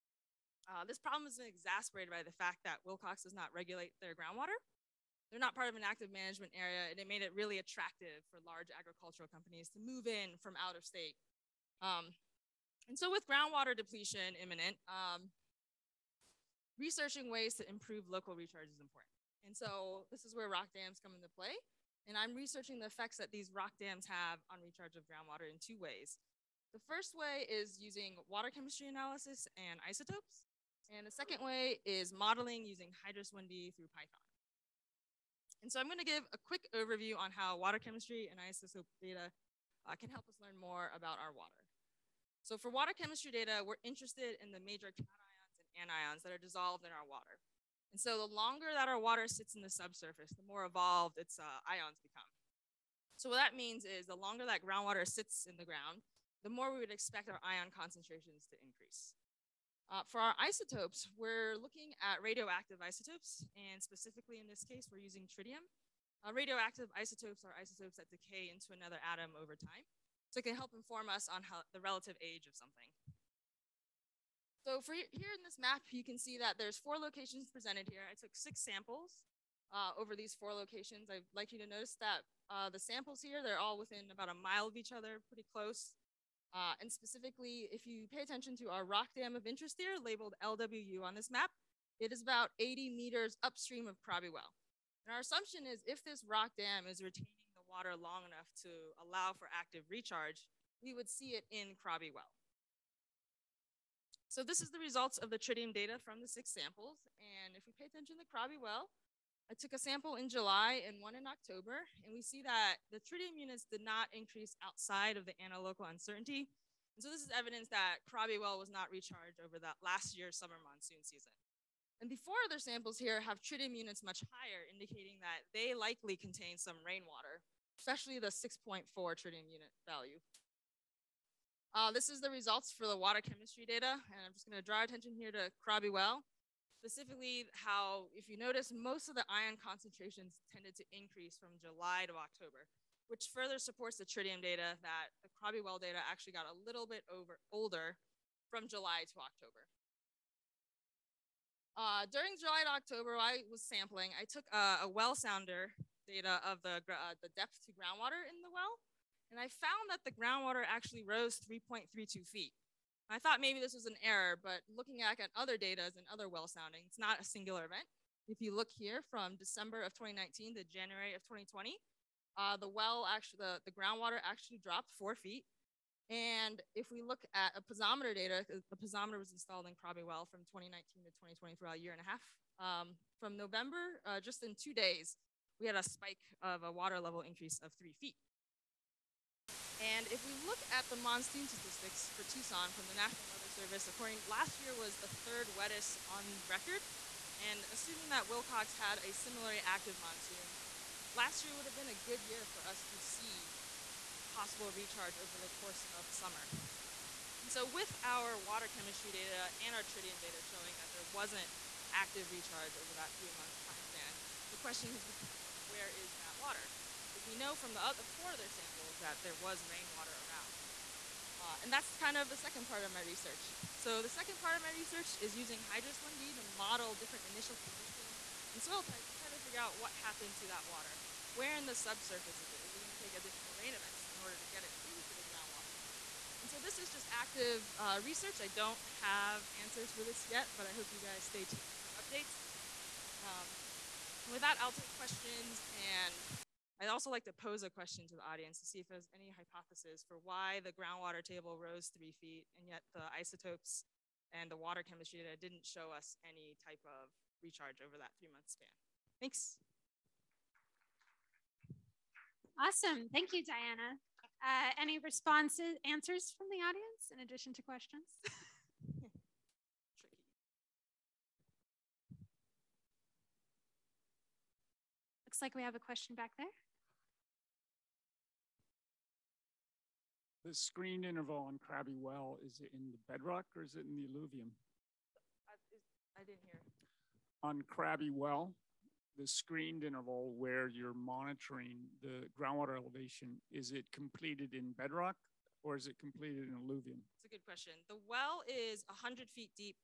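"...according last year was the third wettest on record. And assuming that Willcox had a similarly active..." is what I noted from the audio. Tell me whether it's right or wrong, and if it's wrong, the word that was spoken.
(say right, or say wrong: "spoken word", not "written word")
right.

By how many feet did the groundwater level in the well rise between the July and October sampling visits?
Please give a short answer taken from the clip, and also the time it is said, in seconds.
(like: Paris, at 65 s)
3.32 feet, at 161 s.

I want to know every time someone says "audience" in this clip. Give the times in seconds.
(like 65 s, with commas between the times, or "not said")
248 s, 266 s.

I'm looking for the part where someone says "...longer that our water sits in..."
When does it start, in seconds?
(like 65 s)
48 s.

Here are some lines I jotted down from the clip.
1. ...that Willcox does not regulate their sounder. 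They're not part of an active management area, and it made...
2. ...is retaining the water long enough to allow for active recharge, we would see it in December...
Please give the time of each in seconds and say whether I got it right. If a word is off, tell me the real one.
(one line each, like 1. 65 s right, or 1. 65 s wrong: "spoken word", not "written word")
1. 2 s wrong: "groundwater", not "sounder"
2. 96 s wrong: "Krabi", not "December".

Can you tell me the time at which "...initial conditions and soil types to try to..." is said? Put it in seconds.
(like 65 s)
227 s.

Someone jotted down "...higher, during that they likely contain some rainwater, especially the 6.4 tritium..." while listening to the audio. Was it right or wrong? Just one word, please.
wrong.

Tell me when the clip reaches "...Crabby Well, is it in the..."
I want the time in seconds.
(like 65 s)
281 s.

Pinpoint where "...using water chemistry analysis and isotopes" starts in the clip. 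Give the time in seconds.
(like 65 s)
27 s.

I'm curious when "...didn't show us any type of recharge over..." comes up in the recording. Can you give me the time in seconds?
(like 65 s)
255 s.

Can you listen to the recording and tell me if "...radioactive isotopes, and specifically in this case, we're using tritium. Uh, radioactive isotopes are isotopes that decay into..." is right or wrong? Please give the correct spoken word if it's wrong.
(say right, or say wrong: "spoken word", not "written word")
right.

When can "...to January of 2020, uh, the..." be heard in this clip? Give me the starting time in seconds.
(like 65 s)
170 s.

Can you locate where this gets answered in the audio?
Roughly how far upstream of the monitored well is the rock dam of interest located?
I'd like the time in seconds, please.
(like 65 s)
92 s.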